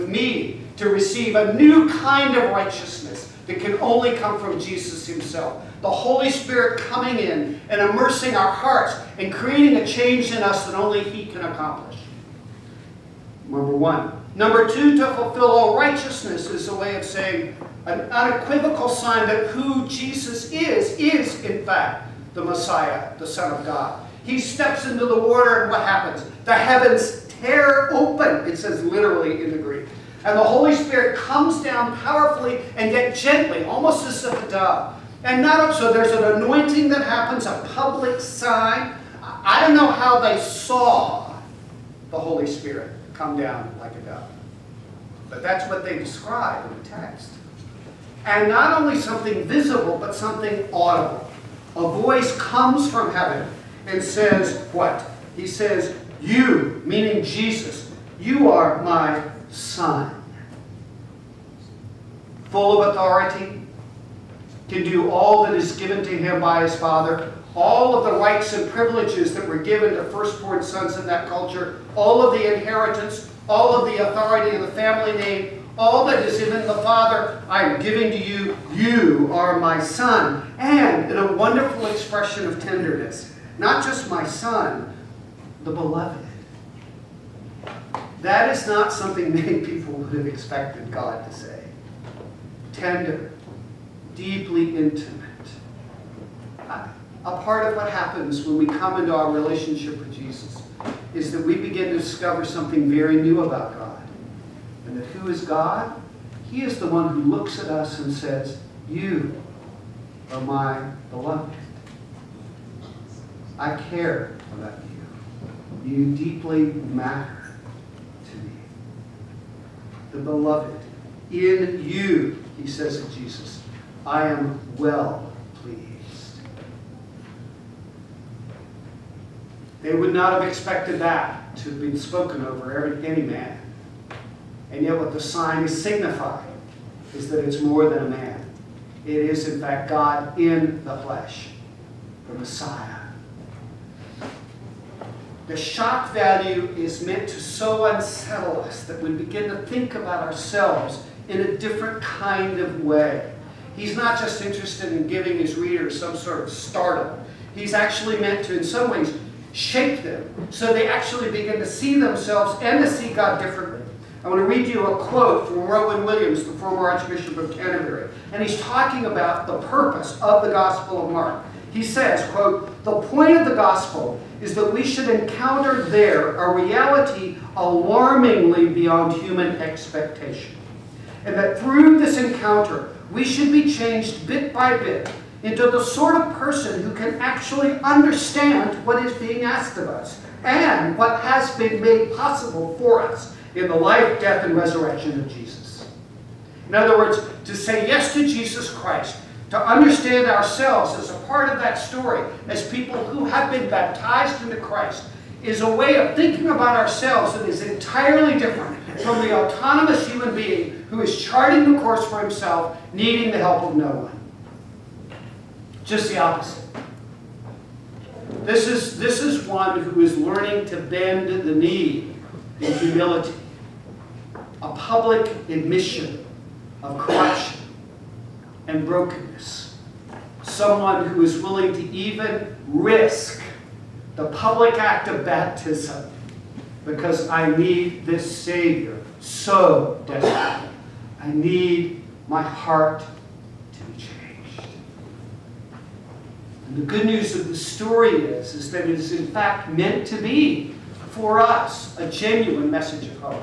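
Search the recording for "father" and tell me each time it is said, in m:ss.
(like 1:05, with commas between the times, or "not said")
1:06, 1:16.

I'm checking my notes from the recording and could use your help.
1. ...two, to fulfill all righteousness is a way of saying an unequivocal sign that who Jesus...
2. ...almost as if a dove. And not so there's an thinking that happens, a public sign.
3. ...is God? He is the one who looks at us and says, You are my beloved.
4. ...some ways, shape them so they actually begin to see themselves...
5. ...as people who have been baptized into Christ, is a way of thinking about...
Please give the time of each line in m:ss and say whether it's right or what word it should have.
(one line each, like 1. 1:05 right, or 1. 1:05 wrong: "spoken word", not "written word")
1. 0:14 right
2. 0:33 wrong: "anointing", not "thinking"
3. 1:45 right
4. 2:38 right
5. 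3:22 right.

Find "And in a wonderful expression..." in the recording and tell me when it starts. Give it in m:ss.
1:20.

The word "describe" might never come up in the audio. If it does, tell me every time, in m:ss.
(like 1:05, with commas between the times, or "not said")
0:45.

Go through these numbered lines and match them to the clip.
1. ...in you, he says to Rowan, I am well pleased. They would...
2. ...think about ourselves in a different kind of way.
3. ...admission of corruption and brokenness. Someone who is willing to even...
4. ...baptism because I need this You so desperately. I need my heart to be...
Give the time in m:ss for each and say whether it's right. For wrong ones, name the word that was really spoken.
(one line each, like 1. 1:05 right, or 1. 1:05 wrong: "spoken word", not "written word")
1. 2:01 wrong: "Jesus", not "Rowan"
2. 2:29 right
3. 3:45 right
4. 3:55 wrong: "Savior", not "You".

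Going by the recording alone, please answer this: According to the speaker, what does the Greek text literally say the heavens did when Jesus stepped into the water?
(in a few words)
Tear open.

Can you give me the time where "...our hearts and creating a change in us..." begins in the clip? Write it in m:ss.
0:08.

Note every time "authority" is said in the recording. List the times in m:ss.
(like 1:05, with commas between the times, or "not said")
1:02, 1:14.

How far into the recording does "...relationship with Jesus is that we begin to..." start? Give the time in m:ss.
1:39.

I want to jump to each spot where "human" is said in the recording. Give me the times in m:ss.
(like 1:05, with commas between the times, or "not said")
2:59, 3:30.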